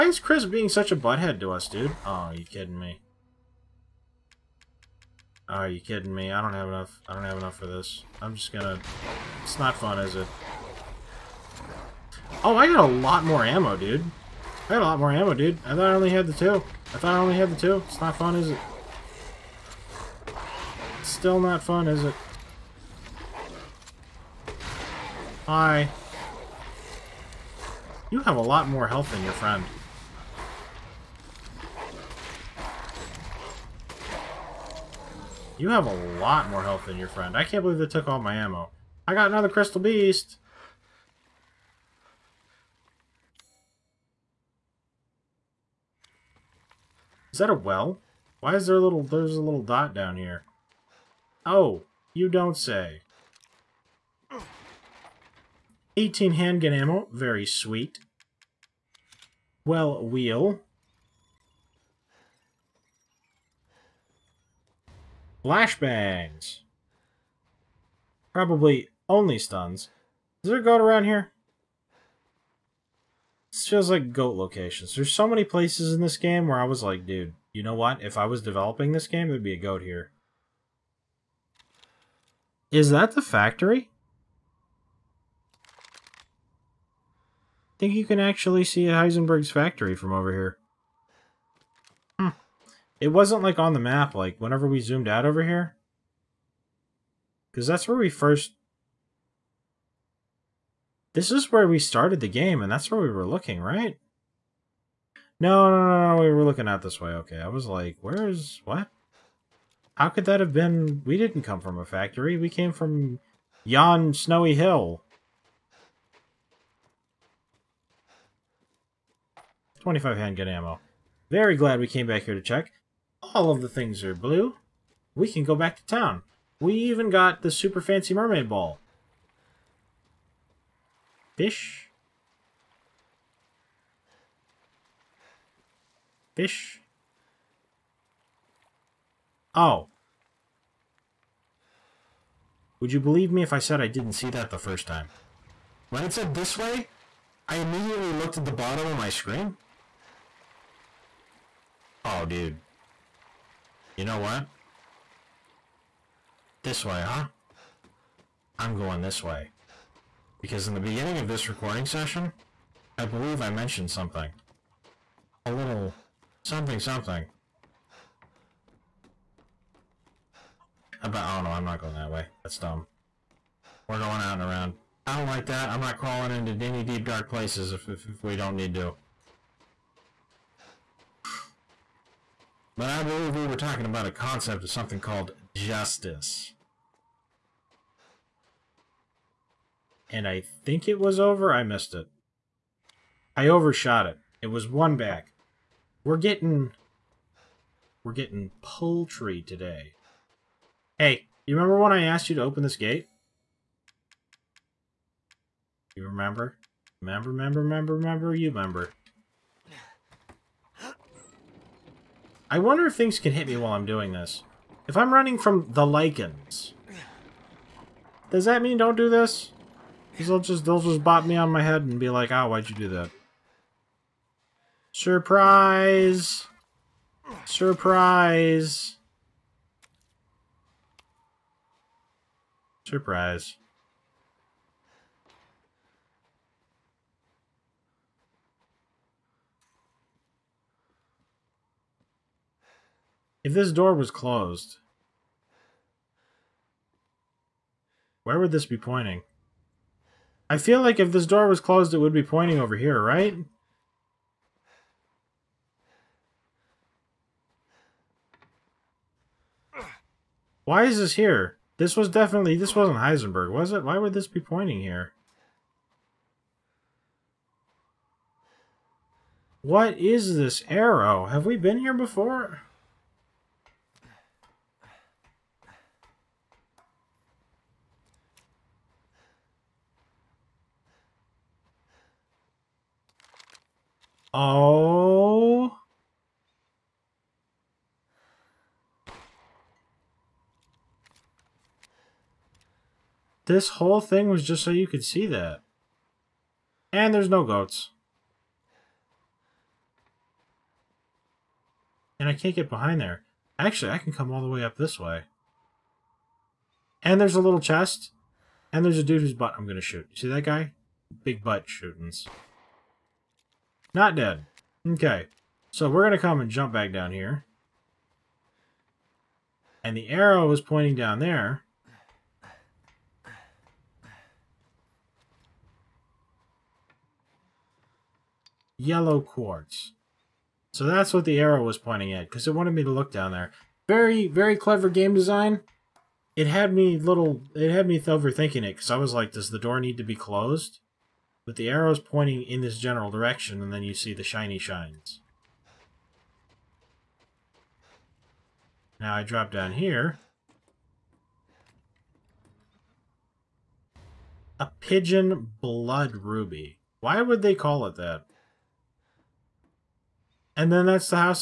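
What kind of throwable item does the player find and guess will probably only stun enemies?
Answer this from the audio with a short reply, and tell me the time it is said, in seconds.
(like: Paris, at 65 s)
Flashbangs, at 65 s.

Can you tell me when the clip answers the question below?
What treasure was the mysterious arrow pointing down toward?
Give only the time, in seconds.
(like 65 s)
328 s.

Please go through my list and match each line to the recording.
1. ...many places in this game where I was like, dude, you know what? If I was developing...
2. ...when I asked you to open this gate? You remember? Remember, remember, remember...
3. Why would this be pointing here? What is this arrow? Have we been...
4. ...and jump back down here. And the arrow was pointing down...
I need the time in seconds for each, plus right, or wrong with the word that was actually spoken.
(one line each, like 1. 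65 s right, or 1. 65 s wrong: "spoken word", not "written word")
1. 75 s right
2. 201 s right
3. 263 s right
4. 316 s right.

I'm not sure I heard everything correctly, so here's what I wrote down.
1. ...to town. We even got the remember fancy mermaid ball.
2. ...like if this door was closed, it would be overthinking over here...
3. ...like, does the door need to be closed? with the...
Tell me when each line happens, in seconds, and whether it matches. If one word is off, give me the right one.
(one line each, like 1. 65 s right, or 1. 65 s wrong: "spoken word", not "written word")
1. 125 s wrong: "super", not "remember"
2. 250 s wrong: "pointing", not "overthinking"
3. 339 s right.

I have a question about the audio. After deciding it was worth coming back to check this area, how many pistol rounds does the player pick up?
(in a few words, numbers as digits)
25.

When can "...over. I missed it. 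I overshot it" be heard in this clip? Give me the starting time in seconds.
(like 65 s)
191 s.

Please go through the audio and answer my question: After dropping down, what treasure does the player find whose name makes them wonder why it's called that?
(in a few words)
Pigeon blood ruby.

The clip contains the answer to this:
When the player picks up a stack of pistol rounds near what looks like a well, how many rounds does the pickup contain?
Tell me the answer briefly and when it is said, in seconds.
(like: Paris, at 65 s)
18, at 55 s.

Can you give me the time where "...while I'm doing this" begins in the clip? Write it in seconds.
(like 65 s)
213 s.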